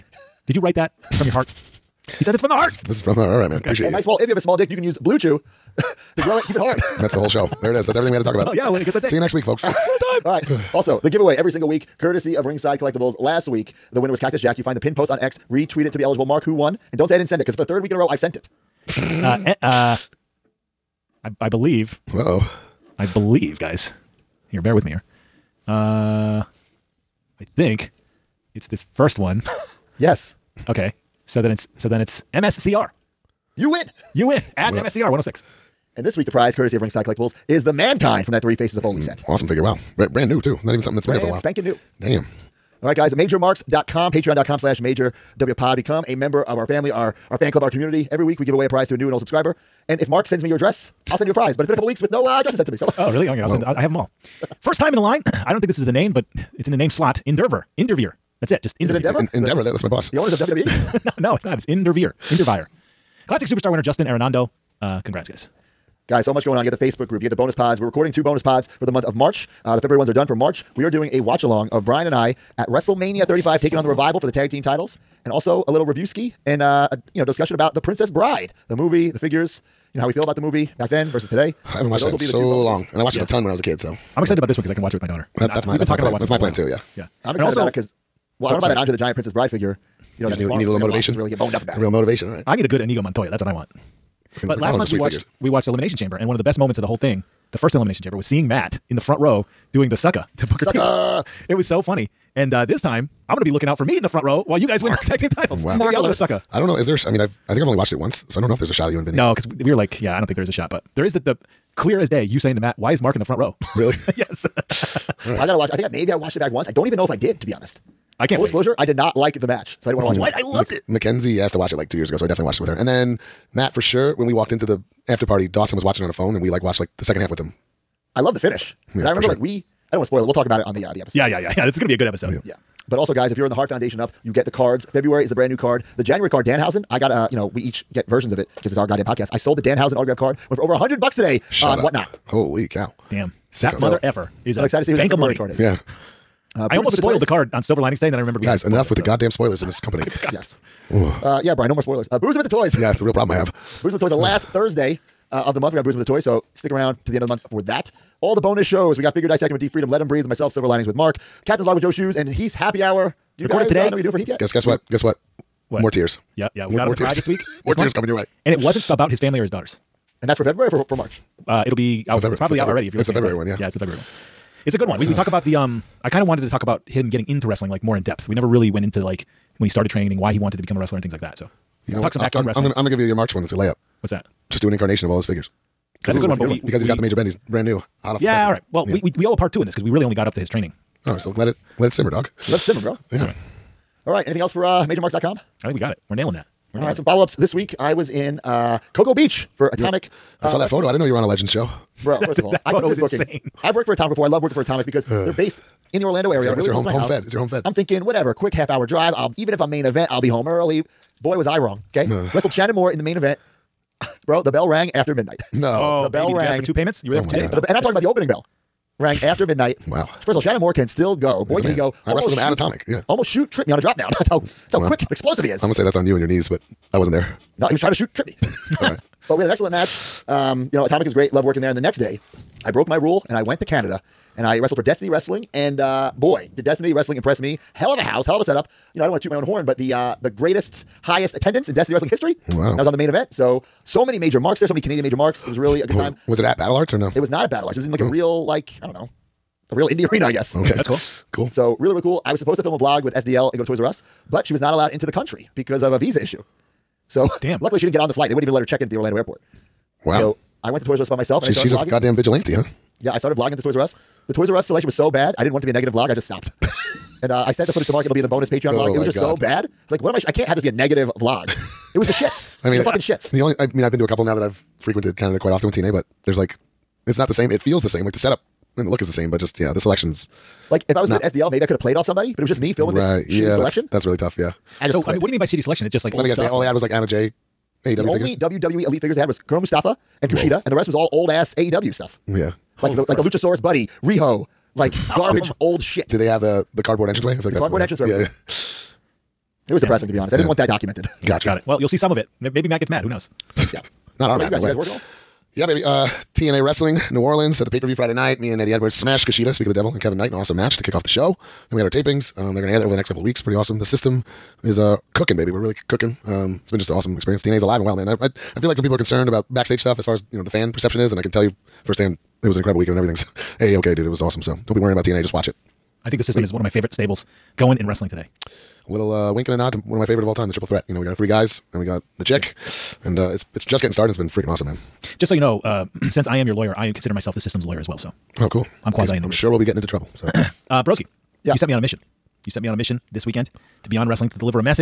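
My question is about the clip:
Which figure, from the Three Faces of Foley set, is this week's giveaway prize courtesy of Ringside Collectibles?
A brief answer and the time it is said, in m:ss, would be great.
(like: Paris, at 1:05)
Mankind, at 0:37.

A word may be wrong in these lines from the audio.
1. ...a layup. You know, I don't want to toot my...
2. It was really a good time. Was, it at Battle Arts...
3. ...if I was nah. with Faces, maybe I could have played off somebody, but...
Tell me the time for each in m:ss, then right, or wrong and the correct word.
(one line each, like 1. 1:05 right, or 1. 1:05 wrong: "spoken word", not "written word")
1. 3:58 wrong: "setup", not "layup"
2. 4:05 right
3. 4:40 wrong: "SDL", not "Faces".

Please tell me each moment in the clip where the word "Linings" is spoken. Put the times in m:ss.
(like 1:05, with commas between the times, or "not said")
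2:27, 2:40.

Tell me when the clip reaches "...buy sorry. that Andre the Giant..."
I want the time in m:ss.
1:28.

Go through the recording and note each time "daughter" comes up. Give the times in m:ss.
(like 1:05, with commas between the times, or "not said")
1:25, 2:49.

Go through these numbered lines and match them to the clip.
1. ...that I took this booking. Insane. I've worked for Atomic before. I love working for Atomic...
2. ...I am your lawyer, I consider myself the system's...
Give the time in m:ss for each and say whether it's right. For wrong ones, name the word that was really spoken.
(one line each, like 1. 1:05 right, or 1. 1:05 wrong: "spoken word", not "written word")
1. 3:22 right
2. 5:36 right.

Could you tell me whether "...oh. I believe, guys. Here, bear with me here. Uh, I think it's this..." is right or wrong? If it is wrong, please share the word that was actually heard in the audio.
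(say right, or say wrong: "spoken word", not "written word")
right.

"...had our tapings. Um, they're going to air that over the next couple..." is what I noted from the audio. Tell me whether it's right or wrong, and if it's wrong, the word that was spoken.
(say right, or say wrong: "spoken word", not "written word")
right.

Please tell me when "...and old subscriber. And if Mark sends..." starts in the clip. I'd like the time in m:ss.
0:49.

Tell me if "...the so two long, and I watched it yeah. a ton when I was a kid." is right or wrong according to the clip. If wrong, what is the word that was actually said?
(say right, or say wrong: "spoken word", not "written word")
right.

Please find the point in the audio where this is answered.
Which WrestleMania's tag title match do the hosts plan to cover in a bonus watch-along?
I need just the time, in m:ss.
1:12.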